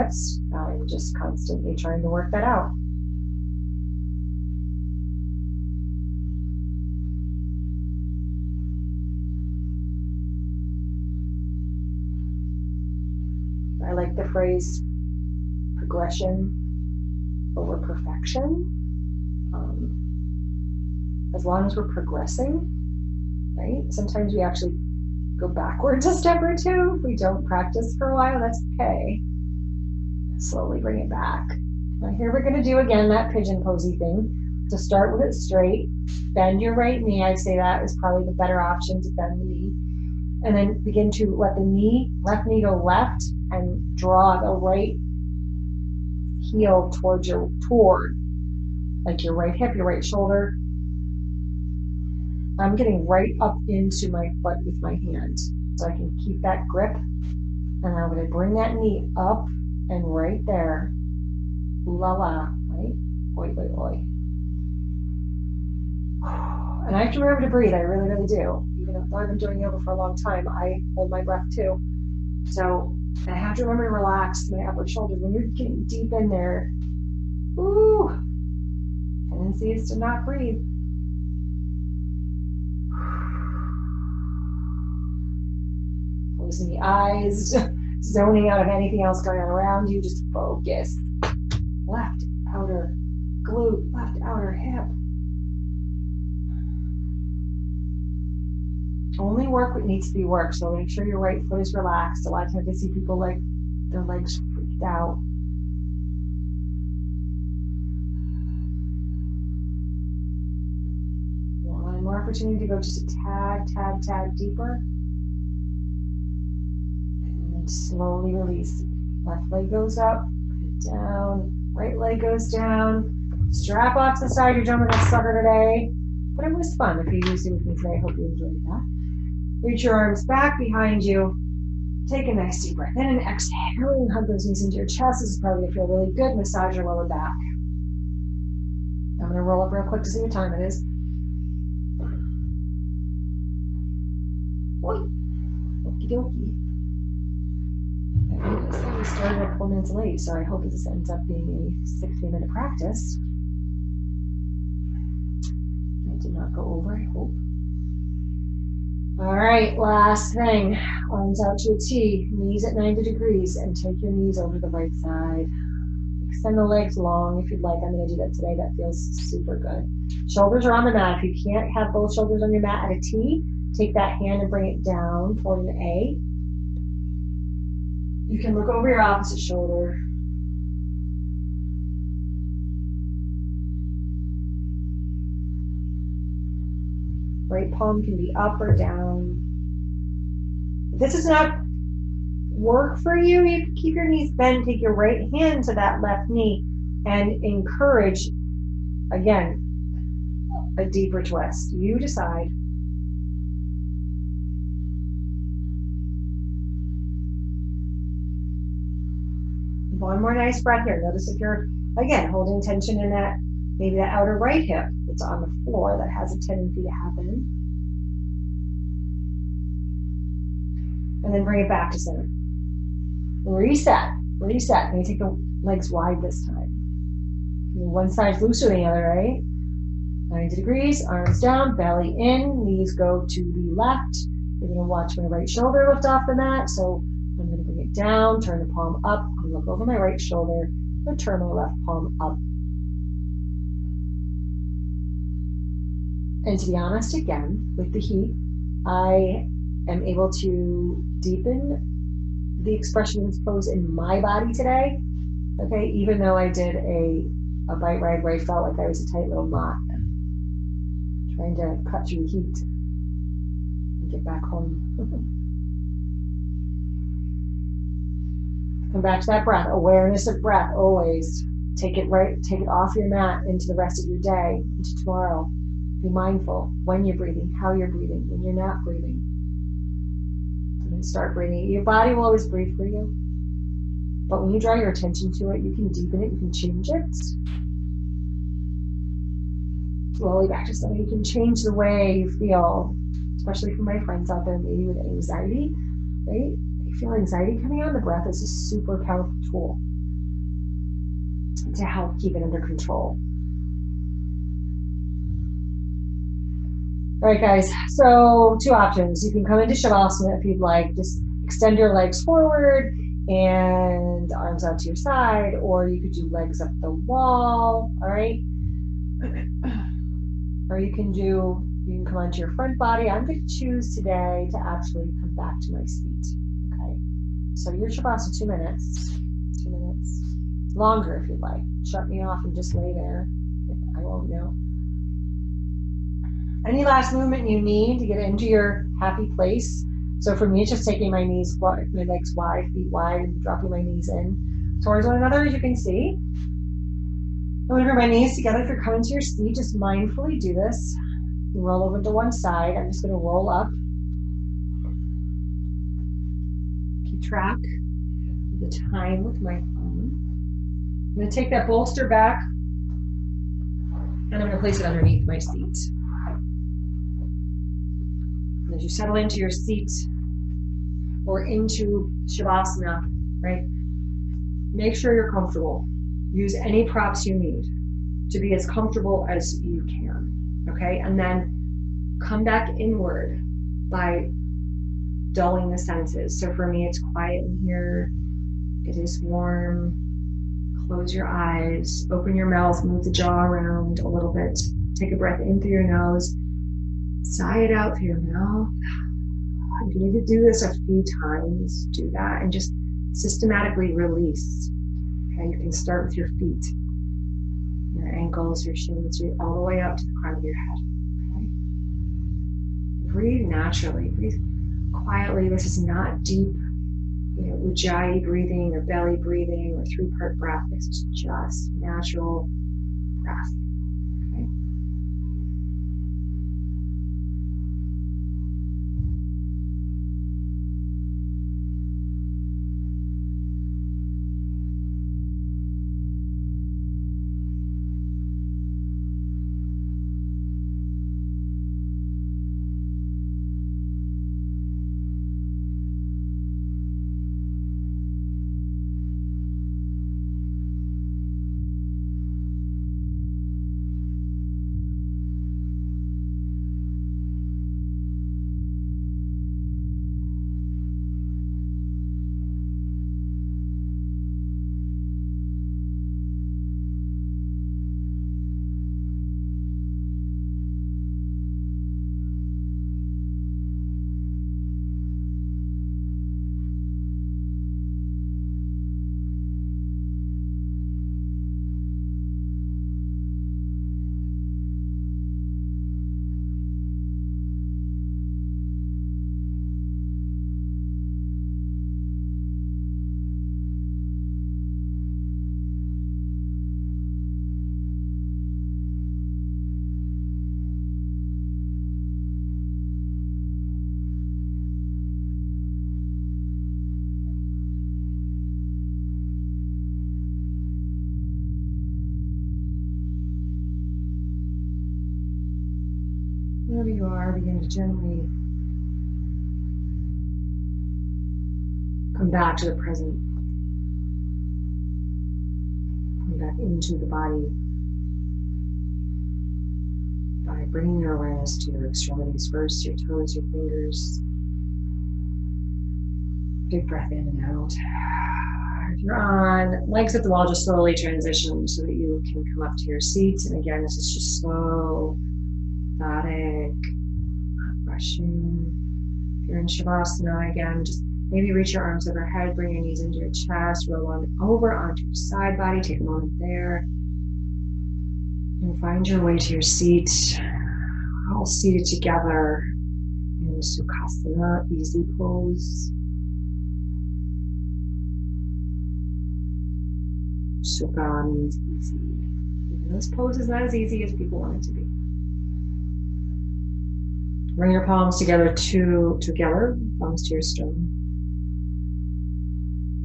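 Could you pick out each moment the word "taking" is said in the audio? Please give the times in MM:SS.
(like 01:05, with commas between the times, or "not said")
05:40.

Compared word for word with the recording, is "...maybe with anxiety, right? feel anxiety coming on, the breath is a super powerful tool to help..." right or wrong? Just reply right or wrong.
right.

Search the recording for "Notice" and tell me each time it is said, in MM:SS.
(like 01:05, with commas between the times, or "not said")
03:31.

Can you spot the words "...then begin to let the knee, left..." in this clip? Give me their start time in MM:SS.
00:40.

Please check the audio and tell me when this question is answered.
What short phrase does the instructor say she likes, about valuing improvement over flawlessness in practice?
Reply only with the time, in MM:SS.
00:15.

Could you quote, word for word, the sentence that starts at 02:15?
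This is probably feel really good.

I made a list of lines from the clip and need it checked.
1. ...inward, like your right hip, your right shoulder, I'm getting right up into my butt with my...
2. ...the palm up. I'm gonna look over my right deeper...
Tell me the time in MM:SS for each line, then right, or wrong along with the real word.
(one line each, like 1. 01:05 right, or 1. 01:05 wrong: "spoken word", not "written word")
1. 00:47 wrong: "toward", not "inward"
2. 03:58 wrong: "shoulder", not "deeper".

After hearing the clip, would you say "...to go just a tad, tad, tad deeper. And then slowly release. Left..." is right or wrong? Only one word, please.
right.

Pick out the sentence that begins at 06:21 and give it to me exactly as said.
And then come back inward by dulling the senses.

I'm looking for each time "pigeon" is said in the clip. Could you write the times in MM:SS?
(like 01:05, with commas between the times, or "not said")
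00:33.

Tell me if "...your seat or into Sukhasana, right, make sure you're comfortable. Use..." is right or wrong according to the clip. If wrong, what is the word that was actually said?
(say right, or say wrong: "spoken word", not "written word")
wrong: "Shavasana", not "Sukhasana".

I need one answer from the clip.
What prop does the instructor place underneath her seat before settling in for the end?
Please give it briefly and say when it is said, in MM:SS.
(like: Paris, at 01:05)
Bolster, at 06:01.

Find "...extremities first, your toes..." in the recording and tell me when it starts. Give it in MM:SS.
08:51.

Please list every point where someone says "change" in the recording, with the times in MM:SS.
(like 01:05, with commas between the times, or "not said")
04:46, 04:51.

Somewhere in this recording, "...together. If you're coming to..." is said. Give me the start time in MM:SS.
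05:48.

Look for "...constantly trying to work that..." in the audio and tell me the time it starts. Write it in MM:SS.
00:01.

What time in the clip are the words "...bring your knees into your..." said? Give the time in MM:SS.
09:12.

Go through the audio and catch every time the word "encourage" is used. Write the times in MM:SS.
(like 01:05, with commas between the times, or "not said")
03:17.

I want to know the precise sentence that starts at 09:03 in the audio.
And again, this is just slow not rushing.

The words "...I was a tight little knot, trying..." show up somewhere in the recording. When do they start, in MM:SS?
04:18.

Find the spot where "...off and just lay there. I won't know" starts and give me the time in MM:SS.
05:32.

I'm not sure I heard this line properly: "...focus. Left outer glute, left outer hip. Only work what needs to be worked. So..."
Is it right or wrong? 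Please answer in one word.
right.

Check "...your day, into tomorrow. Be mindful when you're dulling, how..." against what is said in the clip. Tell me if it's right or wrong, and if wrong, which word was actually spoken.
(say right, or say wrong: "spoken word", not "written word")
wrong: "breathing", not "dulling".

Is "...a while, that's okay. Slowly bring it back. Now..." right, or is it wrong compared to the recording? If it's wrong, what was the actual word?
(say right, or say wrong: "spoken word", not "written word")
right.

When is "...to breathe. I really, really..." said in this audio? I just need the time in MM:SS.
01:07.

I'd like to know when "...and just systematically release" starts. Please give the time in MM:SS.
06:42.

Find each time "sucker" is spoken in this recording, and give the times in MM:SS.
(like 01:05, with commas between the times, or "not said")
02:05.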